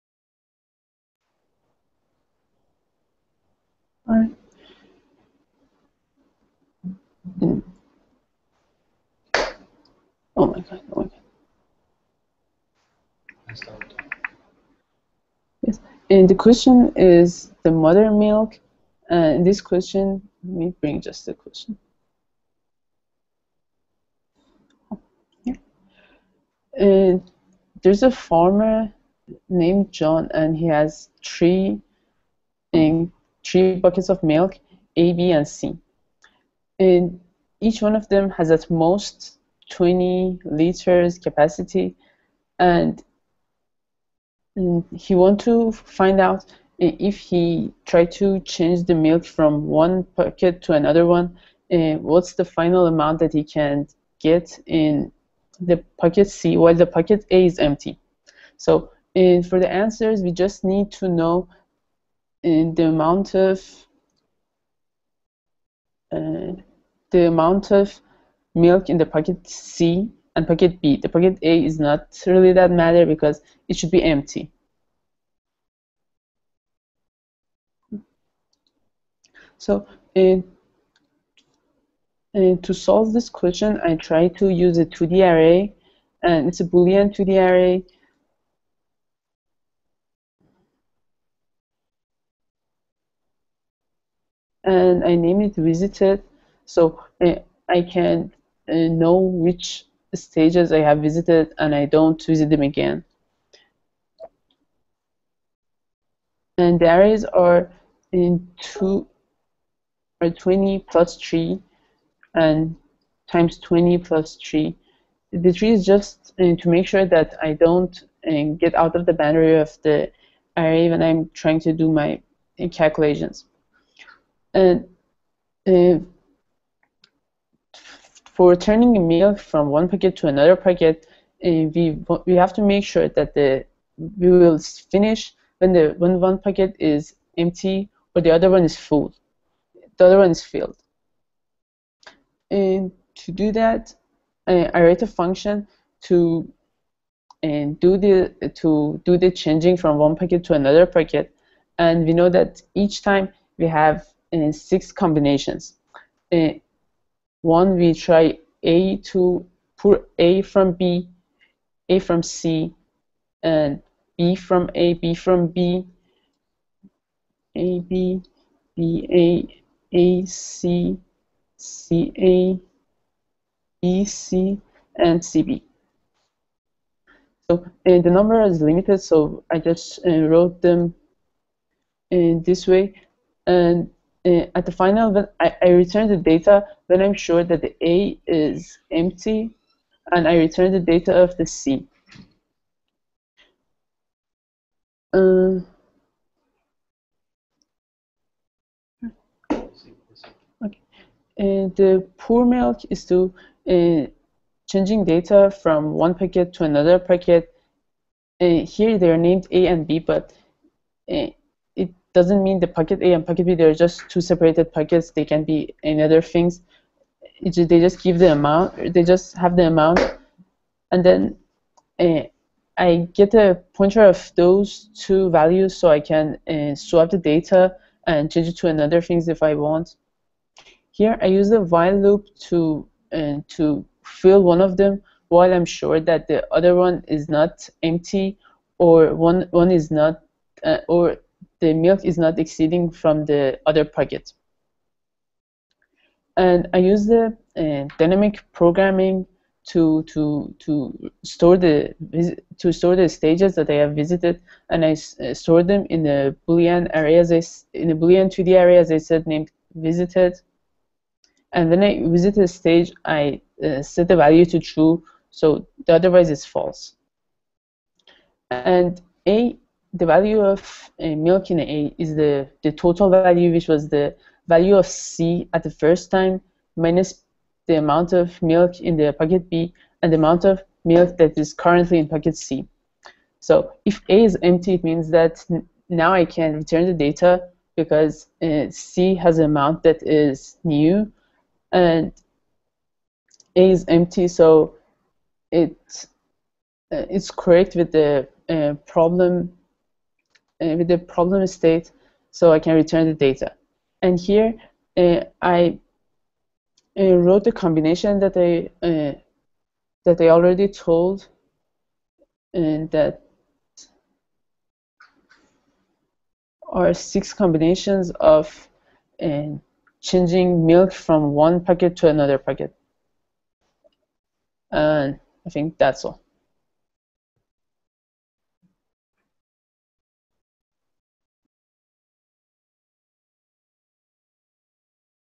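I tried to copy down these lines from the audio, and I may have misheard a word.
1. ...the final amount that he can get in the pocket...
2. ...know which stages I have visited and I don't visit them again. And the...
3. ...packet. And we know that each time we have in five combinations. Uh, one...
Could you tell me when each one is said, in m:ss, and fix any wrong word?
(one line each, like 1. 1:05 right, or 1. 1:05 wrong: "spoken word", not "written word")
1. 0:52 right
2. 1:38 right
3. 2:30 wrong: "six", not "five".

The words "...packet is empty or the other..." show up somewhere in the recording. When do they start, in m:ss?
2:16.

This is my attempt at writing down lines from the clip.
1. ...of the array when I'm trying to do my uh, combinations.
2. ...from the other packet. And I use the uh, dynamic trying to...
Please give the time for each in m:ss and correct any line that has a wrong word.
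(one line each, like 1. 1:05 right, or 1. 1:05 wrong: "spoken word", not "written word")
1. 1:59 wrong: "calculations", not "combinations"
2. 4:02 wrong: "programming", not "trying".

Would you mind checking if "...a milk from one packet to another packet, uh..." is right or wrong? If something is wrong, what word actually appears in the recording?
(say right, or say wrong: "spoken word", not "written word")
right.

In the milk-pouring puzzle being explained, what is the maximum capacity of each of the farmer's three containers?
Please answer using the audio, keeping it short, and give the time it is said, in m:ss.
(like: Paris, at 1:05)
20 liters, at 0:39.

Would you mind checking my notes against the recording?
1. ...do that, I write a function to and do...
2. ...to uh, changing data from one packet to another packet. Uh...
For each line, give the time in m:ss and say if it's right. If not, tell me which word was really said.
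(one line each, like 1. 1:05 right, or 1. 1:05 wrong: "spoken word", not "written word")
1. 2:23 right
2. 3:23 right.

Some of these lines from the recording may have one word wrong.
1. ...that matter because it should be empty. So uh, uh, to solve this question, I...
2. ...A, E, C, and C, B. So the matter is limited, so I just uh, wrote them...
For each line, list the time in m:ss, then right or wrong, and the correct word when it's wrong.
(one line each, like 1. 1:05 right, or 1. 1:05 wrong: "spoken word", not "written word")
1. 1:12 right
2. 2:52 wrong: "number", not "matter".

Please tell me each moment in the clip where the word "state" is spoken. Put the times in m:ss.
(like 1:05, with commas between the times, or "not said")
5:01.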